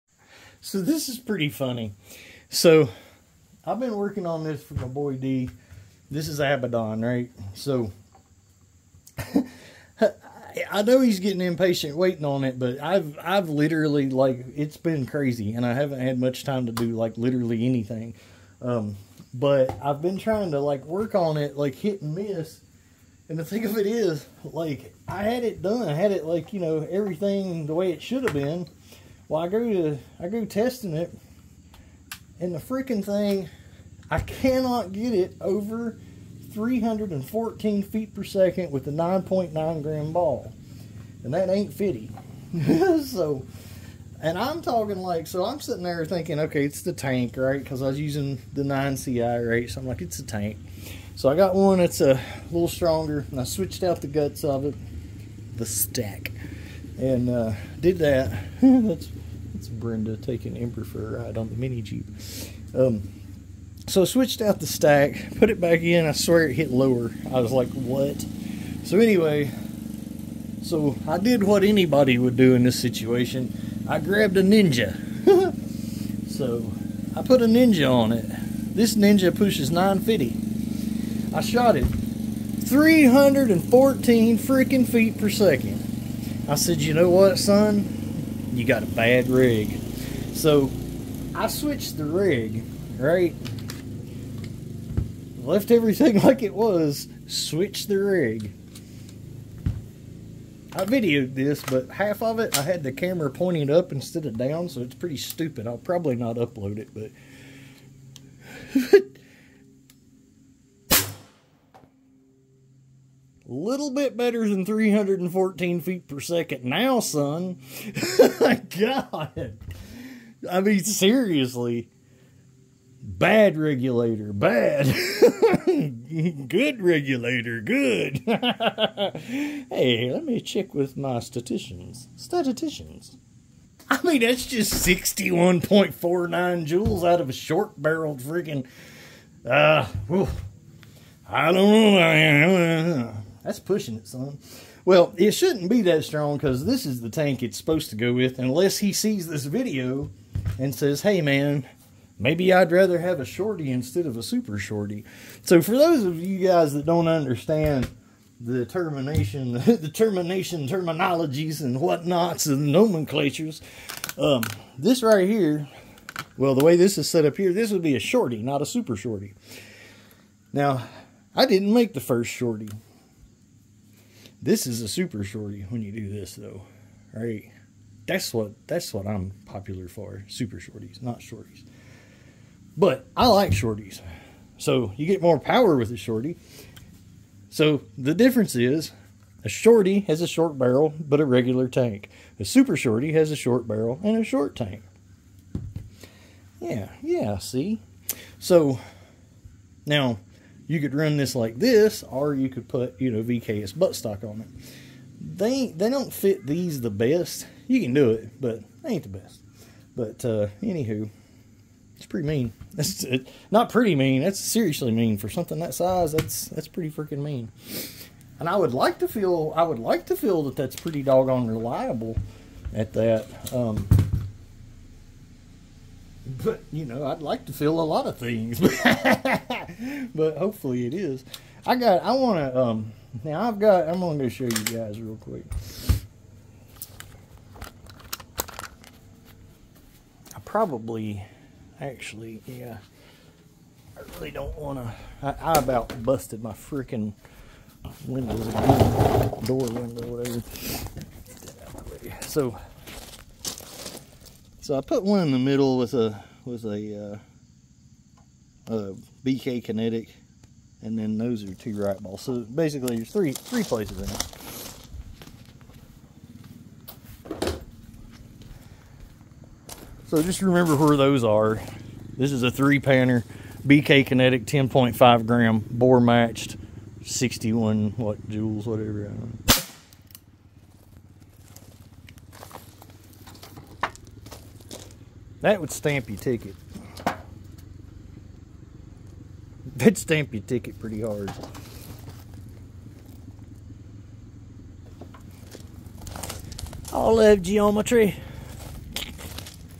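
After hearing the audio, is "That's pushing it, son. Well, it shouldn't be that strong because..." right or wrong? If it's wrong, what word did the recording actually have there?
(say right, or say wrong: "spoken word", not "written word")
right.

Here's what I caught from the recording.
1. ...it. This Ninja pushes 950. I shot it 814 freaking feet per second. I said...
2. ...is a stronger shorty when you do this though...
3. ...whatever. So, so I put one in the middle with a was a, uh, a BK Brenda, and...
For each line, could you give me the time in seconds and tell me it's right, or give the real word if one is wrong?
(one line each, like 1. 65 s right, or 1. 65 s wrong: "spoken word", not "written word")
1. 78 s wrong: "314", not "814"
2. 174 s wrong: "super", not "stronger"
3. 250 s wrong: "Kinetic", not "Brenda".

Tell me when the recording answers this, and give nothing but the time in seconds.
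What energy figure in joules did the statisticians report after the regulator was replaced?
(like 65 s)
134 s.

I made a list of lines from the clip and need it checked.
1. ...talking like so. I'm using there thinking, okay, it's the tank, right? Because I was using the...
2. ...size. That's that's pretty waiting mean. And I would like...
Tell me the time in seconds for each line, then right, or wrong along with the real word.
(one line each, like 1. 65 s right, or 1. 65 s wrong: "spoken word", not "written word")
1. 44 s wrong: "sitting", not "using"
2. 215 s wrong: "freaking", not "waiting".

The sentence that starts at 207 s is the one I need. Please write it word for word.
You can do it, but they ain't the best.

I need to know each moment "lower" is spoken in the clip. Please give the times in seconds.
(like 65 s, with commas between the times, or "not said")
66 s.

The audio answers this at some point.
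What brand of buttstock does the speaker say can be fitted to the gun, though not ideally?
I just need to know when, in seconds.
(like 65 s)
203 s.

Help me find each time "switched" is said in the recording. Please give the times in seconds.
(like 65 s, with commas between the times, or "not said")
53 s, 64 s, 91 s, 97 s.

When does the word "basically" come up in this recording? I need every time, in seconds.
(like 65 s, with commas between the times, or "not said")
262 s.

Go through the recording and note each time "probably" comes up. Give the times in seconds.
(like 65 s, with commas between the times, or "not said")
105 s, 240 s.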